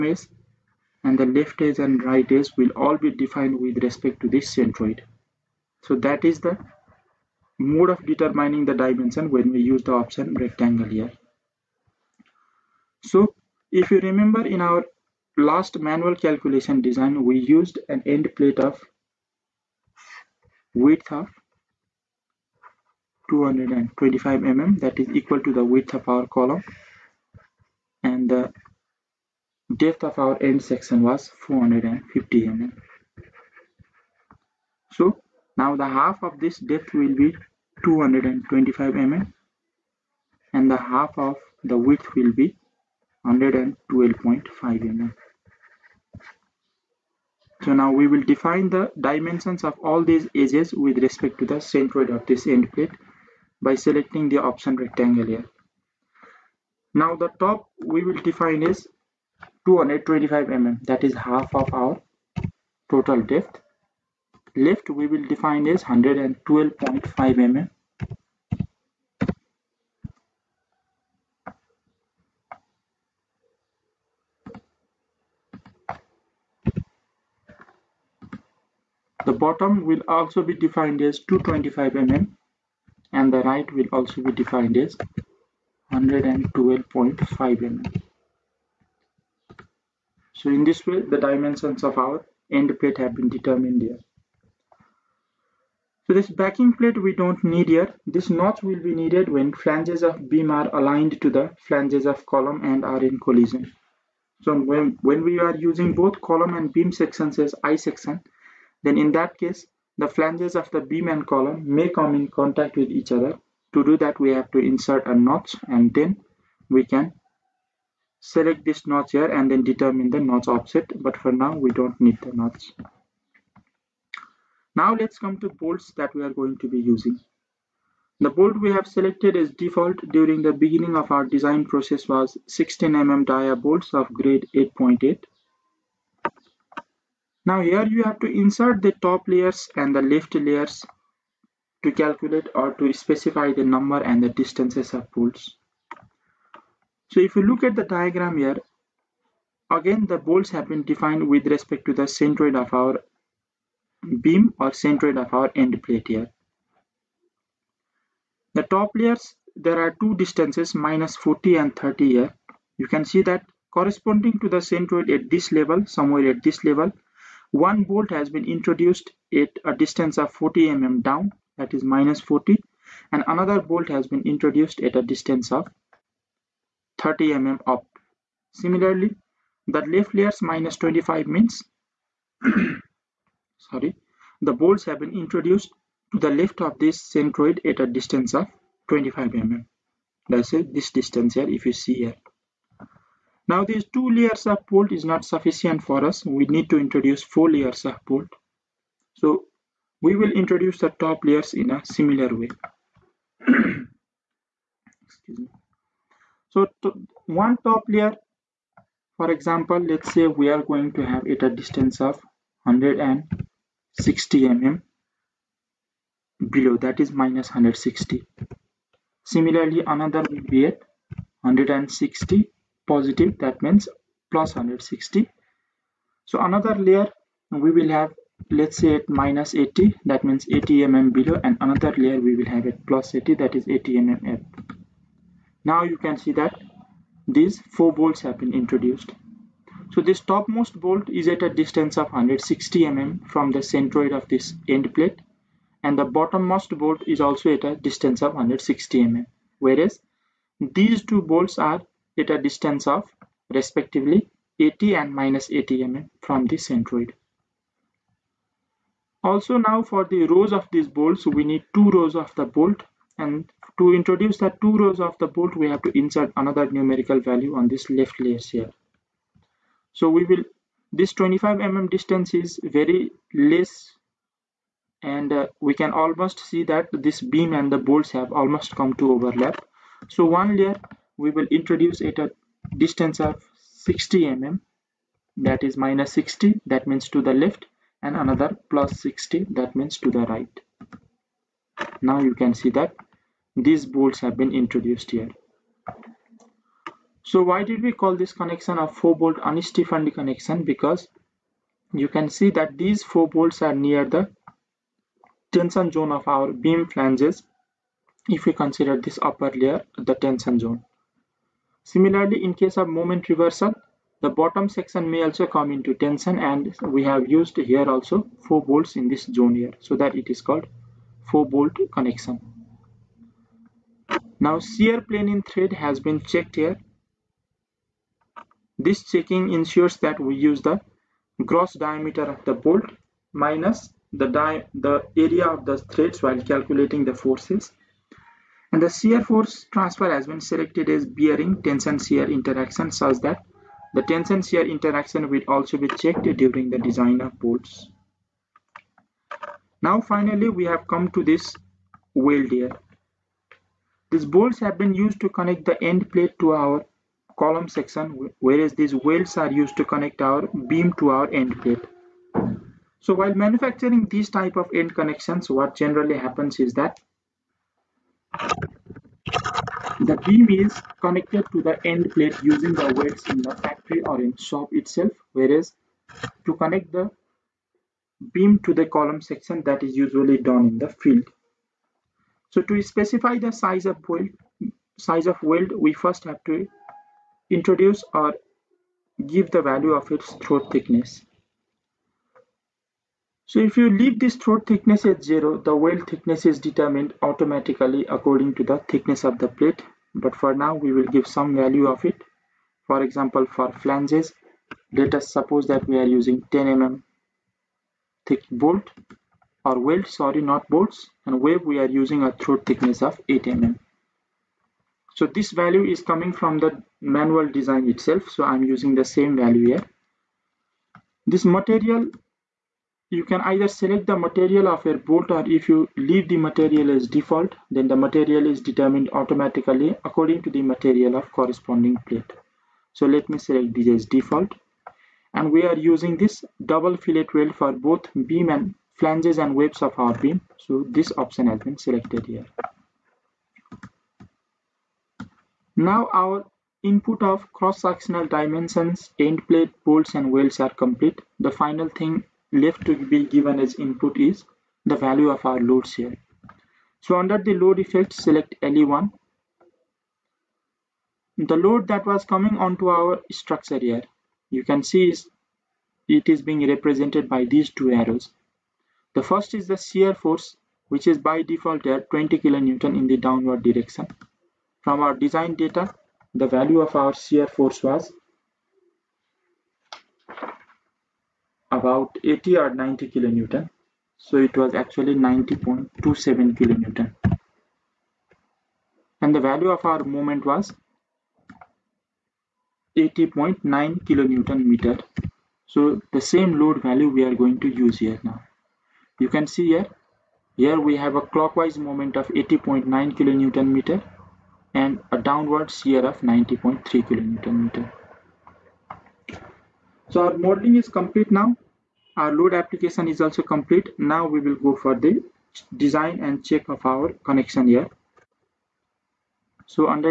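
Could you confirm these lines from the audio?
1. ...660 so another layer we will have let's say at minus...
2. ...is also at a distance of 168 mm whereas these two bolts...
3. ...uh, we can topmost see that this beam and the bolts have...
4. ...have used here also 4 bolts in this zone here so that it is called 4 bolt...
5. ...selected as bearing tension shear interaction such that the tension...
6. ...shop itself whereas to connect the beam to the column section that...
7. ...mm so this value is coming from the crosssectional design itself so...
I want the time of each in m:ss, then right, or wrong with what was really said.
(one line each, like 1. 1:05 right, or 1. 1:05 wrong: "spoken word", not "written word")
1. 3:44 wrong: "160", not "660"
2. 4:07 wrong: "160", not "168"
3. 4:35 wrong: "almost", not "topmost"
4. 5:17 right
5. 5:40 right
6. 6:14 right
7. 6:53 wrong: "manual", not "crosssectional".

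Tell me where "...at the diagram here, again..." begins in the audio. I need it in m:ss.
2:27.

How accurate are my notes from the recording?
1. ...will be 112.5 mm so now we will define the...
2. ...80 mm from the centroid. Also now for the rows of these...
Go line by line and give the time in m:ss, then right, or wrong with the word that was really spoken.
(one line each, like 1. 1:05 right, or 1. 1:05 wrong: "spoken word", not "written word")
1. 0:42 right
2. 4:15 right.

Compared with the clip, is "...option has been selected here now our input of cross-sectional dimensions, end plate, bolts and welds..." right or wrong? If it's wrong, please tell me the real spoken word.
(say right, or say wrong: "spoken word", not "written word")
right.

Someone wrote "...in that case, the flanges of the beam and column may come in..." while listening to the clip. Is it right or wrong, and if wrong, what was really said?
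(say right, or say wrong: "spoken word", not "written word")
right.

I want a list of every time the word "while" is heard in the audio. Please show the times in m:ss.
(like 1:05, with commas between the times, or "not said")
5:36, 6:03.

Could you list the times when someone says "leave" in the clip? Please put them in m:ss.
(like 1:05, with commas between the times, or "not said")
6:33, 7:05.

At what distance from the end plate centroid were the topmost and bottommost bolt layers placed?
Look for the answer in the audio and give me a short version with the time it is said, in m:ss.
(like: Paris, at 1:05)
160 mm, at 3:32.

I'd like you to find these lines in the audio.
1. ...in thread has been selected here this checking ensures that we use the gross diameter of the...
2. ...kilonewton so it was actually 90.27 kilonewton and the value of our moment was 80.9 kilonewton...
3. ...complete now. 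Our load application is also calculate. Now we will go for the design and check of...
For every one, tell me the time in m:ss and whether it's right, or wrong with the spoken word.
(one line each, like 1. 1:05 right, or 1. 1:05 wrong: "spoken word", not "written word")
1. 5:25 wrong: "checked", not "selected"
2. 8:03 right
3. 8:30 wrong: "complete", not "calculate".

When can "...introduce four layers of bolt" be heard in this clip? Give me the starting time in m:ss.
3:16.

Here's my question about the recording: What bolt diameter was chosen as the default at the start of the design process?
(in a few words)
16 mm.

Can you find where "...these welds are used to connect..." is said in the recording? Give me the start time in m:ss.
5:58.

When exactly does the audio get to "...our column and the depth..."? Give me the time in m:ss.
0:26.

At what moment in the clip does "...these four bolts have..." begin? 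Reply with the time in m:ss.
3:57.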